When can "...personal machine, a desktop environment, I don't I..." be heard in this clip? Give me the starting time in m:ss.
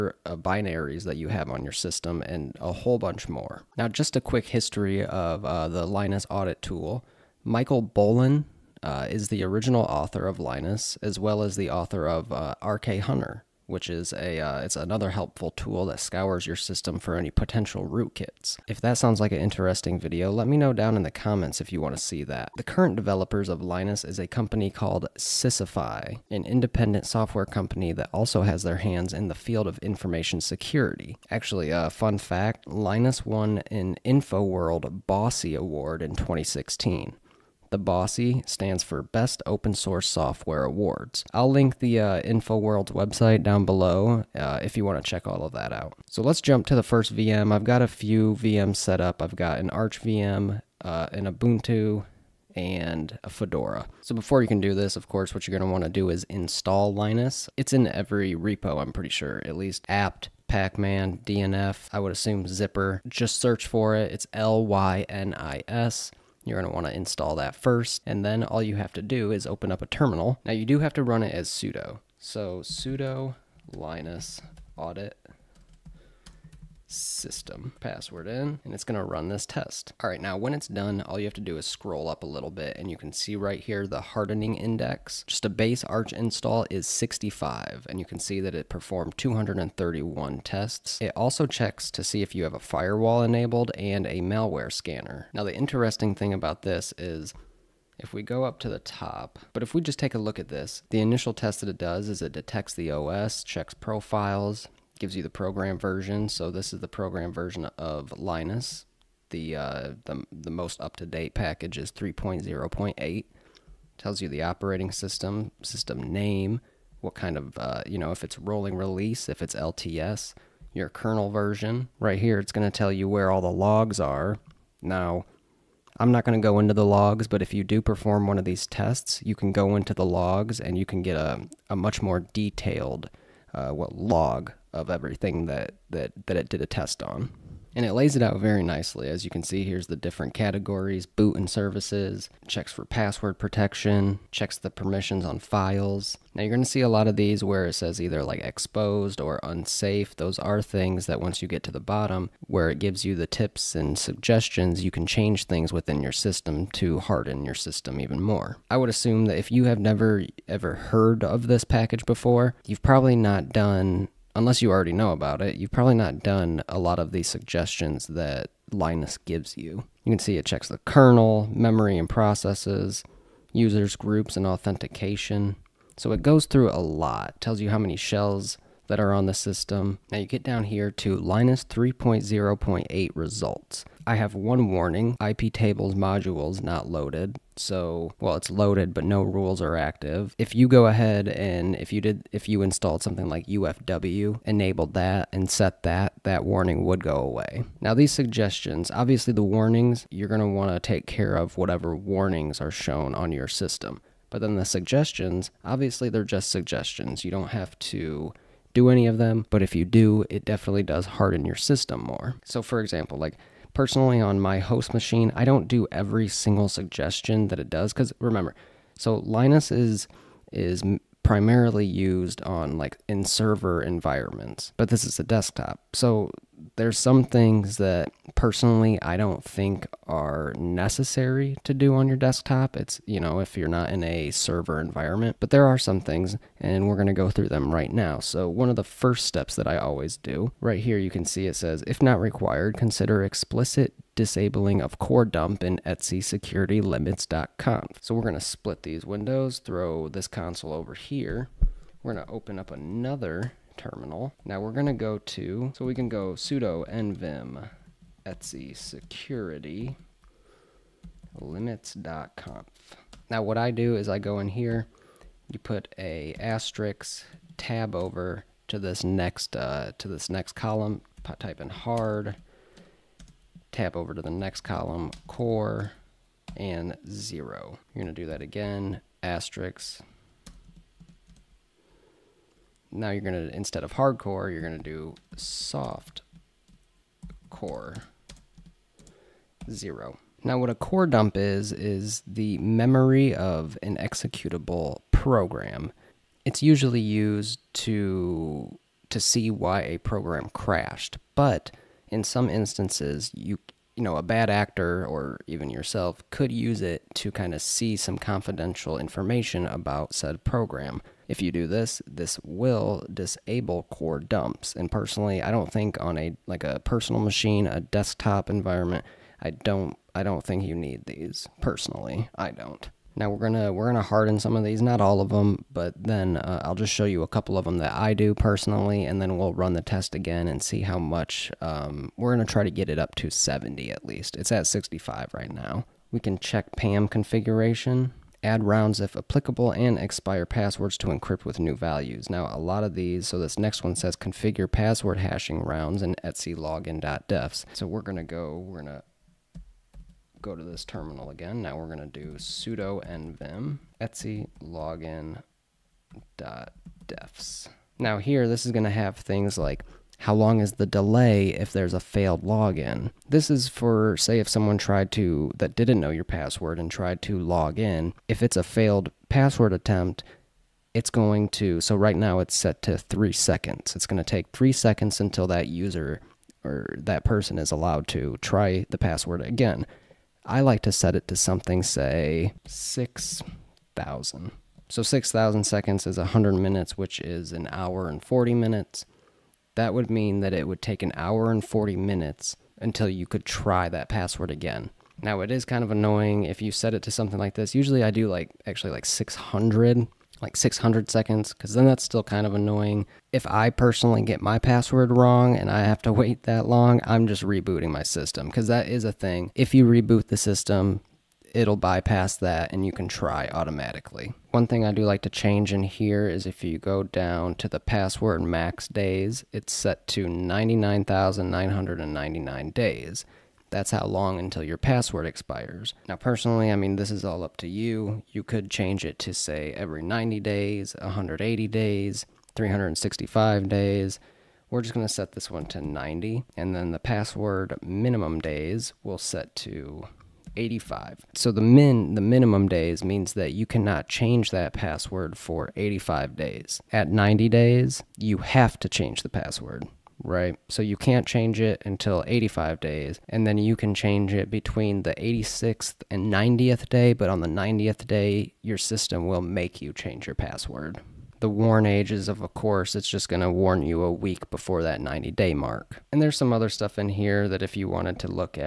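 5:16.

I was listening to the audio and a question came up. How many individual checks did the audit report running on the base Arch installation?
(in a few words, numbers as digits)
231.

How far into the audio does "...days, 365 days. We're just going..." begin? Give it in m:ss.
7:11.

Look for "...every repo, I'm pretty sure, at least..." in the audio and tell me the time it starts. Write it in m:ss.
0:57.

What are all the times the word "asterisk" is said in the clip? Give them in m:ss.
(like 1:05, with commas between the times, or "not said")
4:26, 4:39.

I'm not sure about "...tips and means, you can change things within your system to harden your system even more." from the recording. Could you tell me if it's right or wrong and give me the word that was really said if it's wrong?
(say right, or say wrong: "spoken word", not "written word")
wrong: "suggestions", not "means".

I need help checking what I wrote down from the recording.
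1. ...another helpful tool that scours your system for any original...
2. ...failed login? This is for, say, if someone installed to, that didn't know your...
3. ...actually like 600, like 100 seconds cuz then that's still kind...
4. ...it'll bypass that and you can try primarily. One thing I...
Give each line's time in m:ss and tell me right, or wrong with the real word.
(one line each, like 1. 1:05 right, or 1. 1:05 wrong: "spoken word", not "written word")
1. 0:14 wrong: "potential", not "original"
2. 6:02 wrong: "tried", not "installed"
3. 6:38 wrong: "600", not "100"
4. 6:51 wrong: "automatically", not "primarily".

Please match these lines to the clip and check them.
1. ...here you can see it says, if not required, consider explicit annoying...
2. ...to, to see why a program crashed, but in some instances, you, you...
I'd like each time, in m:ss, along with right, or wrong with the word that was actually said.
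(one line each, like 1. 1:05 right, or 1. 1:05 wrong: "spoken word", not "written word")
1. 4:00 wrong: "disabling", not "annoying"
2. 4:57 right.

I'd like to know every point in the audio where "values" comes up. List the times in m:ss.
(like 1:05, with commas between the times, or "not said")
5:41.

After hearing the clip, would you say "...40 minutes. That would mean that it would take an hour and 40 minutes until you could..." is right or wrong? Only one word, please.
right.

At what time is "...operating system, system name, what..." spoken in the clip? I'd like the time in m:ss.
1:54.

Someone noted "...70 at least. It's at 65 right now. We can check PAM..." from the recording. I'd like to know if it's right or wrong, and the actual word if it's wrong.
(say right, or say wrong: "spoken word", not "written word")
right.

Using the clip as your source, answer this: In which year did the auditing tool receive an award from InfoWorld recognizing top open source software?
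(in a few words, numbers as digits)
2016.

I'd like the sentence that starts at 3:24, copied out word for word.
But then the suggestions, obviously they're just suggestions.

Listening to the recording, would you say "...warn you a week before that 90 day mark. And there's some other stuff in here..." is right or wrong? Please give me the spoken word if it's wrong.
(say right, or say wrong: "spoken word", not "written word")
right.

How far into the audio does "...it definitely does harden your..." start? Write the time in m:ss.
3:30.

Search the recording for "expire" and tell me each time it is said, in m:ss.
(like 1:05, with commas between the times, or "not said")
5:39, 7:05.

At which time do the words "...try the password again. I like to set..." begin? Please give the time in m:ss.
6:18.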